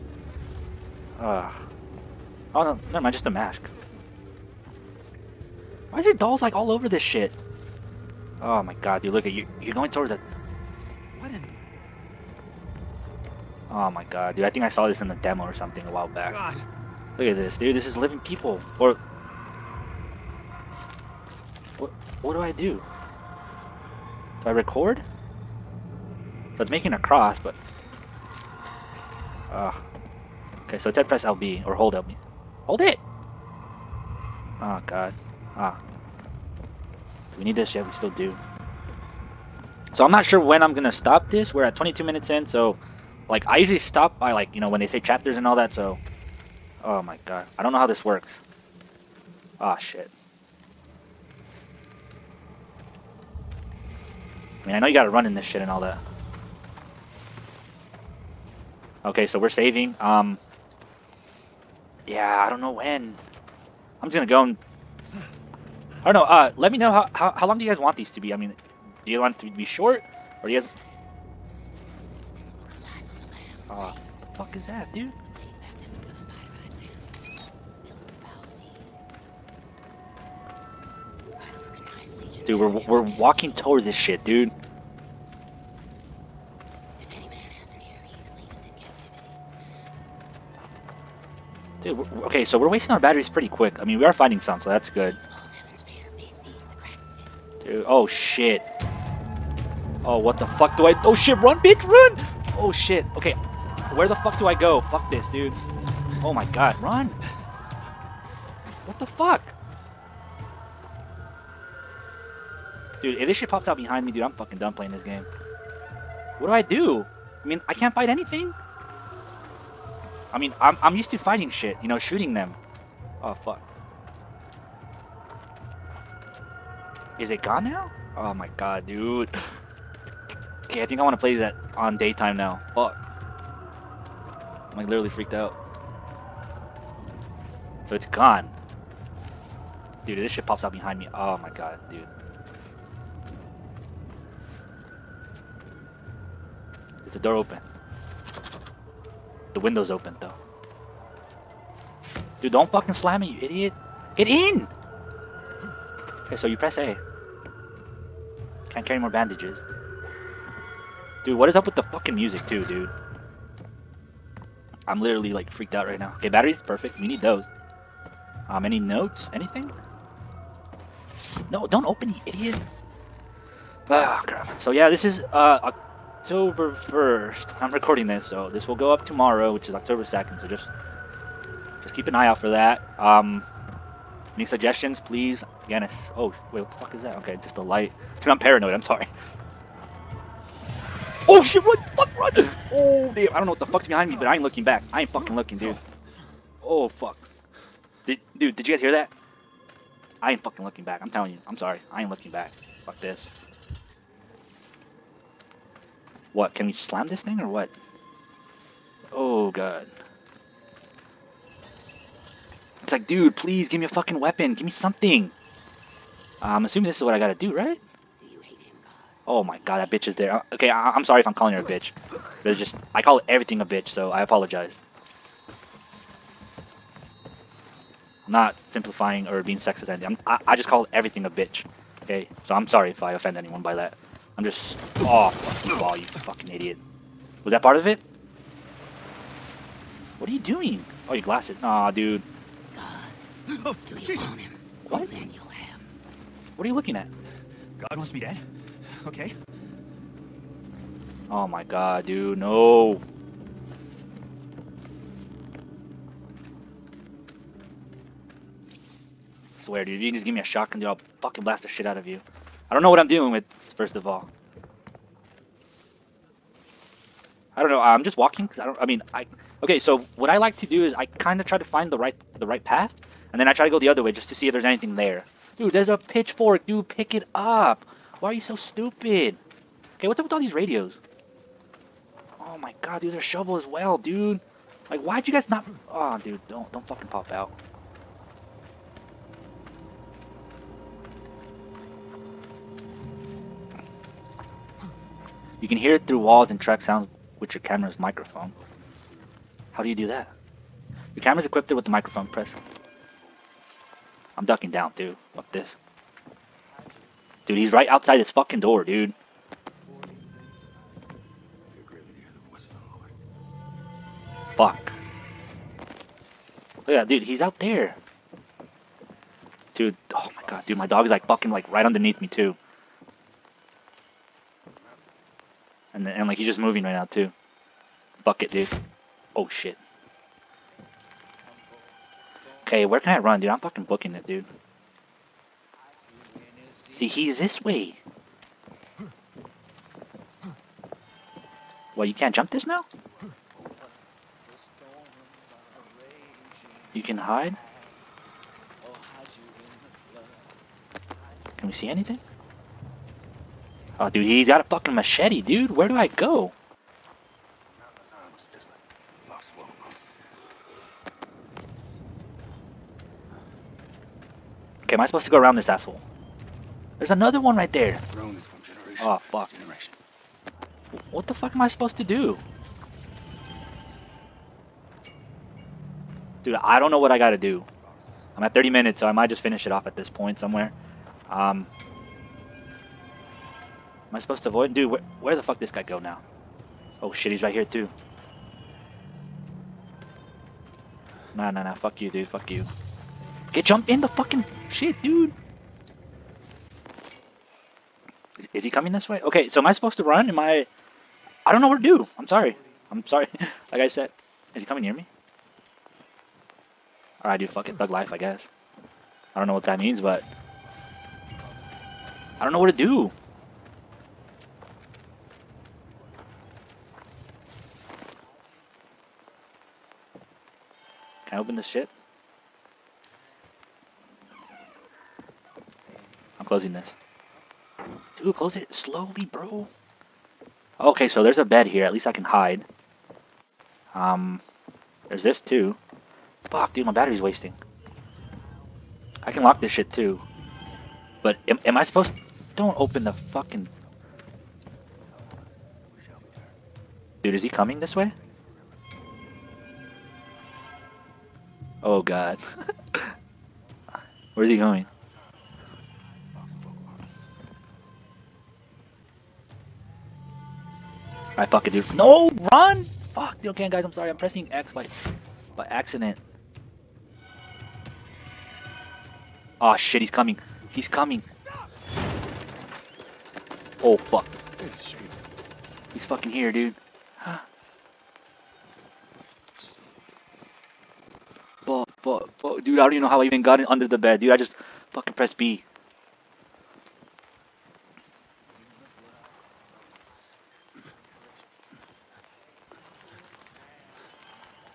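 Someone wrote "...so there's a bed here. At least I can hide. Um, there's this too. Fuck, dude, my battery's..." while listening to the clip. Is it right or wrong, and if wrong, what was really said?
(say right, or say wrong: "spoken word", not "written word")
right.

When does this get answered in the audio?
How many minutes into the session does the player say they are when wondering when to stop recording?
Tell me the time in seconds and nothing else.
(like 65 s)
41 s.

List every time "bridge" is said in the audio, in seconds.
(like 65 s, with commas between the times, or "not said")
not said.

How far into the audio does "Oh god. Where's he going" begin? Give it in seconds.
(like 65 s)
451 s.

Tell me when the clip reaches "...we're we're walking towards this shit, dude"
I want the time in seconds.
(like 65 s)
82 s.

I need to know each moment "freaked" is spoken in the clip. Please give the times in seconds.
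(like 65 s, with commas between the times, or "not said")
135 s, 165 s.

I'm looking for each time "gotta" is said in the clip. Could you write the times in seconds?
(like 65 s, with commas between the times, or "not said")
54 s, 217 s, 377 s.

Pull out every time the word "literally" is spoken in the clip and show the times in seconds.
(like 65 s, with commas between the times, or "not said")
134 s, 165 s.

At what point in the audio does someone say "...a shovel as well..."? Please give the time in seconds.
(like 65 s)
283 s.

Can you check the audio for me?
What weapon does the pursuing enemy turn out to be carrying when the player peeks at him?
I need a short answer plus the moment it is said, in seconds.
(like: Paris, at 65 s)
Machete, at 354 s.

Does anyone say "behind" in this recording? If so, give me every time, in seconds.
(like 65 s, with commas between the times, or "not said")
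113 s, 140 s, 193 s.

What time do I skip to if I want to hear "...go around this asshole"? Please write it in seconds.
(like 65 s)
365 s.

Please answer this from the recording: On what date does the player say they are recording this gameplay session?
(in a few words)
October 1st.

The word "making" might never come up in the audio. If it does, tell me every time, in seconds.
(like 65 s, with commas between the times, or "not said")
26 s.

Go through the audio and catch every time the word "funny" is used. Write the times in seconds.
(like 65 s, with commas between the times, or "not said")
not said.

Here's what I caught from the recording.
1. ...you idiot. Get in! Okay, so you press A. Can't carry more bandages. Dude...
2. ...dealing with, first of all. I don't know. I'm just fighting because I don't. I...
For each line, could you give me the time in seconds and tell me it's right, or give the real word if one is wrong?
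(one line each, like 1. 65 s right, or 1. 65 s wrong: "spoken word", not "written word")
1. 153 s right
2. 263 s wrong: "walking", not "fighting".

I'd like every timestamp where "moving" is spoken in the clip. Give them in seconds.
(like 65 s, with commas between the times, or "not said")
326 s.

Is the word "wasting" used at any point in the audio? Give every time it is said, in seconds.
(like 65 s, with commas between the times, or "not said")
92 s, 437 s.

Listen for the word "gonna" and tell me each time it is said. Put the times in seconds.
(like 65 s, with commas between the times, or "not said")
40 s, 64 s.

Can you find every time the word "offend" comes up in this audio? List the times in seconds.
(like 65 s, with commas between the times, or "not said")
233 s.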